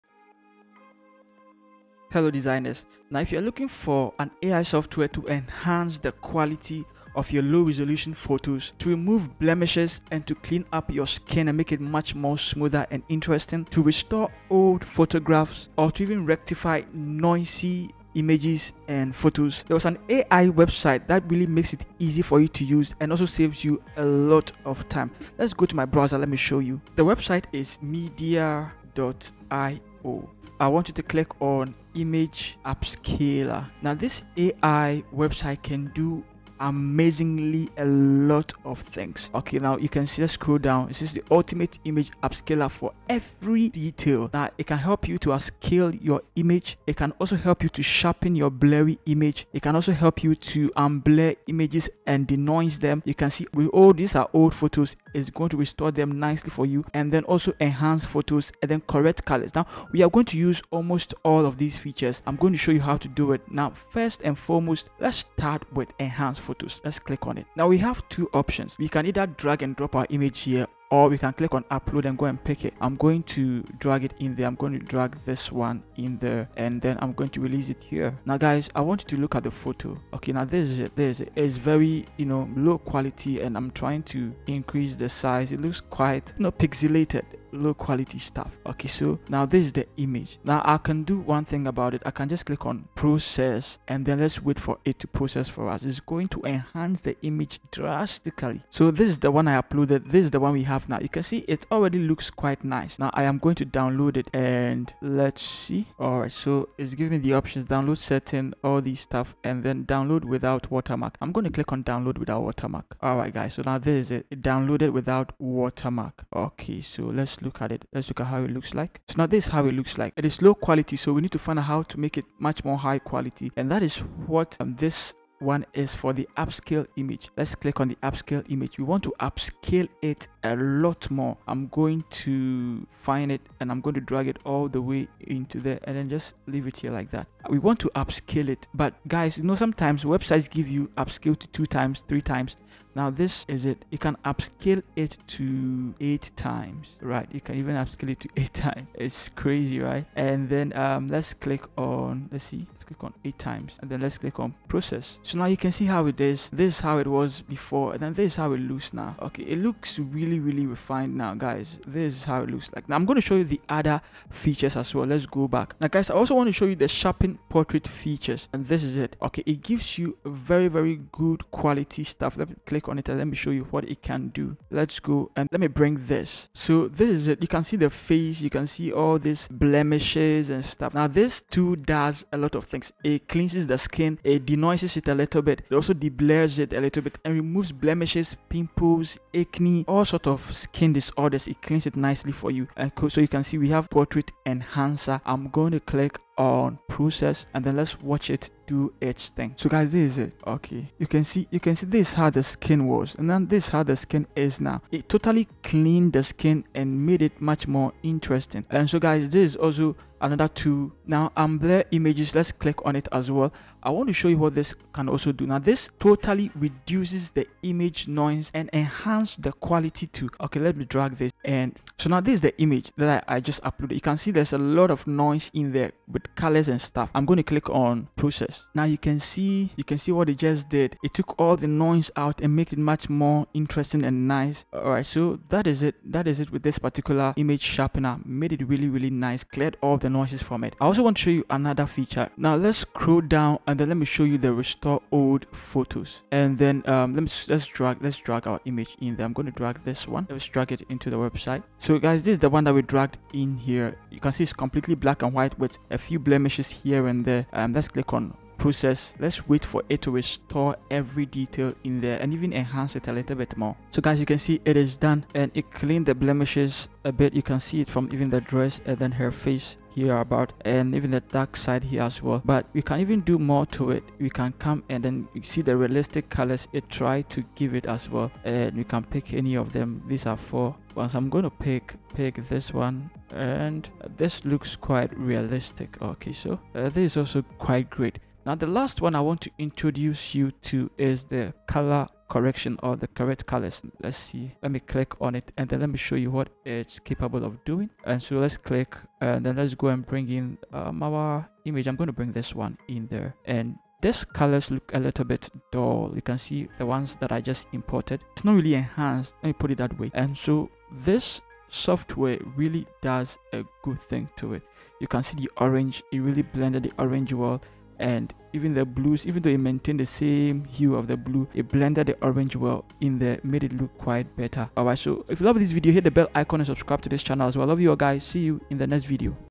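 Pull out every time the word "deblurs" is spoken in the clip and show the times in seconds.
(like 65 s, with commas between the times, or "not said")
185 s.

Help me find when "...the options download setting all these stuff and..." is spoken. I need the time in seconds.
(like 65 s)
107 s.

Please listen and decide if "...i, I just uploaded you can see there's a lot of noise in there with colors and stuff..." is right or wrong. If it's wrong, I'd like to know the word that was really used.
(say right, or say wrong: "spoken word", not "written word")
right.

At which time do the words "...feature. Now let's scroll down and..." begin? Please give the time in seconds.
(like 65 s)
241 s.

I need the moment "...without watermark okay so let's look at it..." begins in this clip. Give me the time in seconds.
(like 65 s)
114 s.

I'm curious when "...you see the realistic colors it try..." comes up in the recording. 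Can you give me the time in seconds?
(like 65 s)
275 s.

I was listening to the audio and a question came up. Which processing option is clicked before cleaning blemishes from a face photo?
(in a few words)
Portrait enhancer.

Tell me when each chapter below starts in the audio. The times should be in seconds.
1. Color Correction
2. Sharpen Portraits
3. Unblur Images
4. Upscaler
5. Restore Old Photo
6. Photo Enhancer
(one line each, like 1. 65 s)
1. 290 s
2. 166 s
3. 211 s
4. 120 s
5. 240 s
6. 65 s.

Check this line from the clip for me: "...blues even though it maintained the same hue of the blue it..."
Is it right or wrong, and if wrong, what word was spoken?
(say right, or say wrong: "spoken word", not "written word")
right.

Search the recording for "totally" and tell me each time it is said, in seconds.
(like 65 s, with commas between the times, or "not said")
205 s, 215 s.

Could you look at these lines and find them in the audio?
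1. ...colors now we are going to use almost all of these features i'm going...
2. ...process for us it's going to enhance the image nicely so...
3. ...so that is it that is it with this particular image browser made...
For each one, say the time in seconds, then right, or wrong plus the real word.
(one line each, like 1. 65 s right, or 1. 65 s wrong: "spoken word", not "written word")
1. 59 s right
2. 95 s wrong: "drastically", not "nicely"
3. 235 s wrong: "sharpener", not "browser".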